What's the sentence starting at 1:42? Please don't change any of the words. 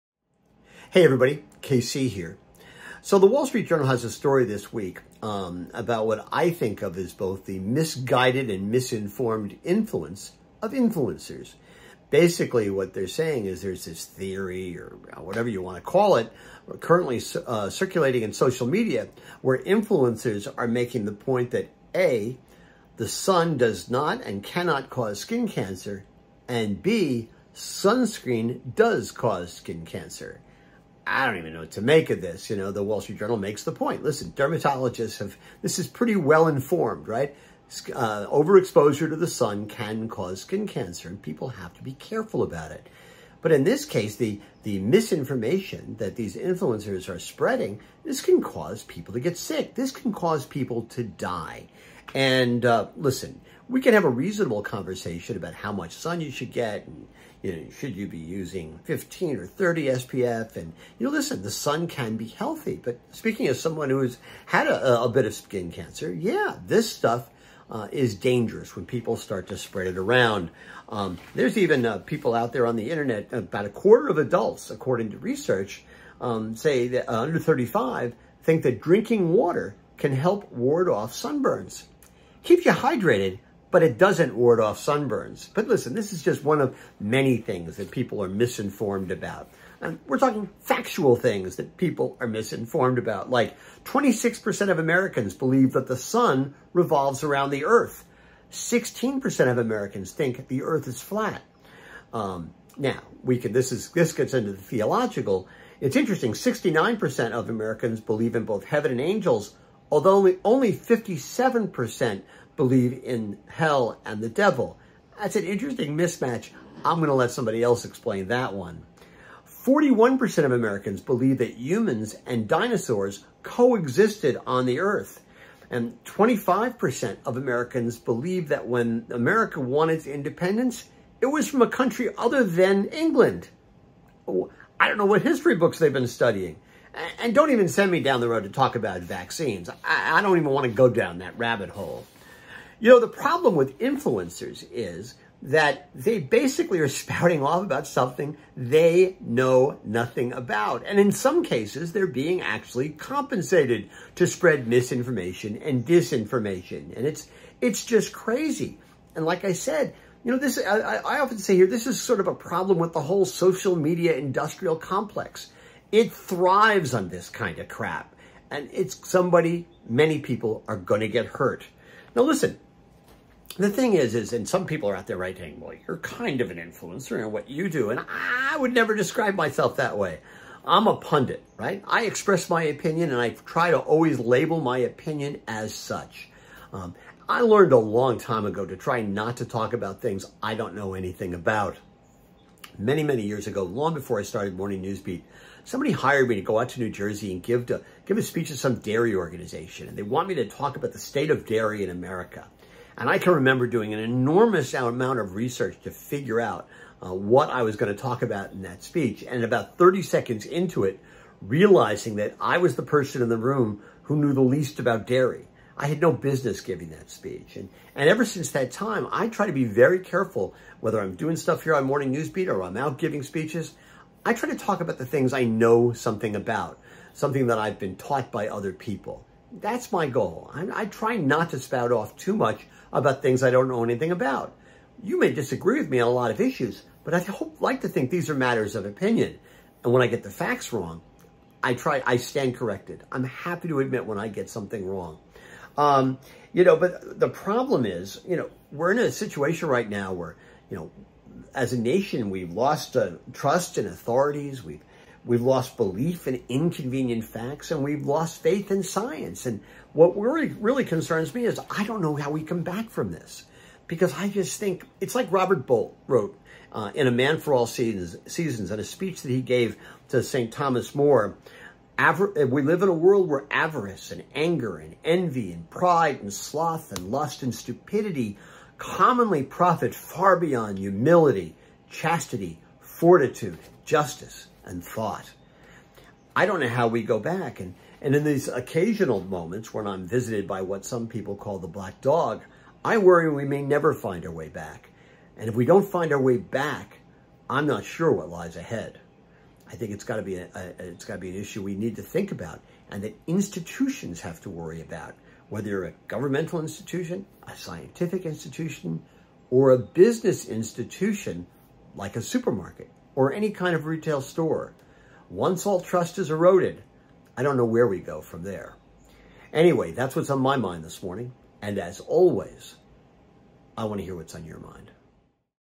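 Um, now, we can, this, is, this gets into the theological.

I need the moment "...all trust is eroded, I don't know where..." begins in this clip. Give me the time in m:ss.
5:15.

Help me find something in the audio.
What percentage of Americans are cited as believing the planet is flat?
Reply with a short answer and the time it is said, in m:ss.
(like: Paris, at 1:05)
16%, at 1:38.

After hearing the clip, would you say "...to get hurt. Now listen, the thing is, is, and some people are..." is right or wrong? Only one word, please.
right.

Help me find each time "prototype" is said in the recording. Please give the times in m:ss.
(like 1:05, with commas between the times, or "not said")
not said.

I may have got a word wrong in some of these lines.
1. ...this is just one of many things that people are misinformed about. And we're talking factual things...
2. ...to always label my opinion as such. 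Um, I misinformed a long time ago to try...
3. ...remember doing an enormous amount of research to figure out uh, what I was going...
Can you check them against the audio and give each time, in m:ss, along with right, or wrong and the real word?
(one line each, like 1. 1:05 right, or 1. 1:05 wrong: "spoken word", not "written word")
1. 1:25 right
2. 3:03 wrong: "learned", not "misinformed"
3. 3:23 right.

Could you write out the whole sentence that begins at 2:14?
Oh, I don't know what history books they've been studying.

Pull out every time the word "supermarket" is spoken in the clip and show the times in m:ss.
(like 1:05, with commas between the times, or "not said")
5:12.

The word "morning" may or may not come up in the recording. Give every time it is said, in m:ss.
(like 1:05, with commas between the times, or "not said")
3:14, 3:41, 5:21.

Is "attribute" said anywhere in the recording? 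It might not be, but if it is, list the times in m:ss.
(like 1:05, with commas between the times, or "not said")
not said.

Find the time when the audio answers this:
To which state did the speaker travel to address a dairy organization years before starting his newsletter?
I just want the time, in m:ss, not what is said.
3:16.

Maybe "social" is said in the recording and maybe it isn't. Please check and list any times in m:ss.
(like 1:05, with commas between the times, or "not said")
0:18, 2:43.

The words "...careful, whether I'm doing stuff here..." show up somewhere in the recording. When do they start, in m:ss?
3:39.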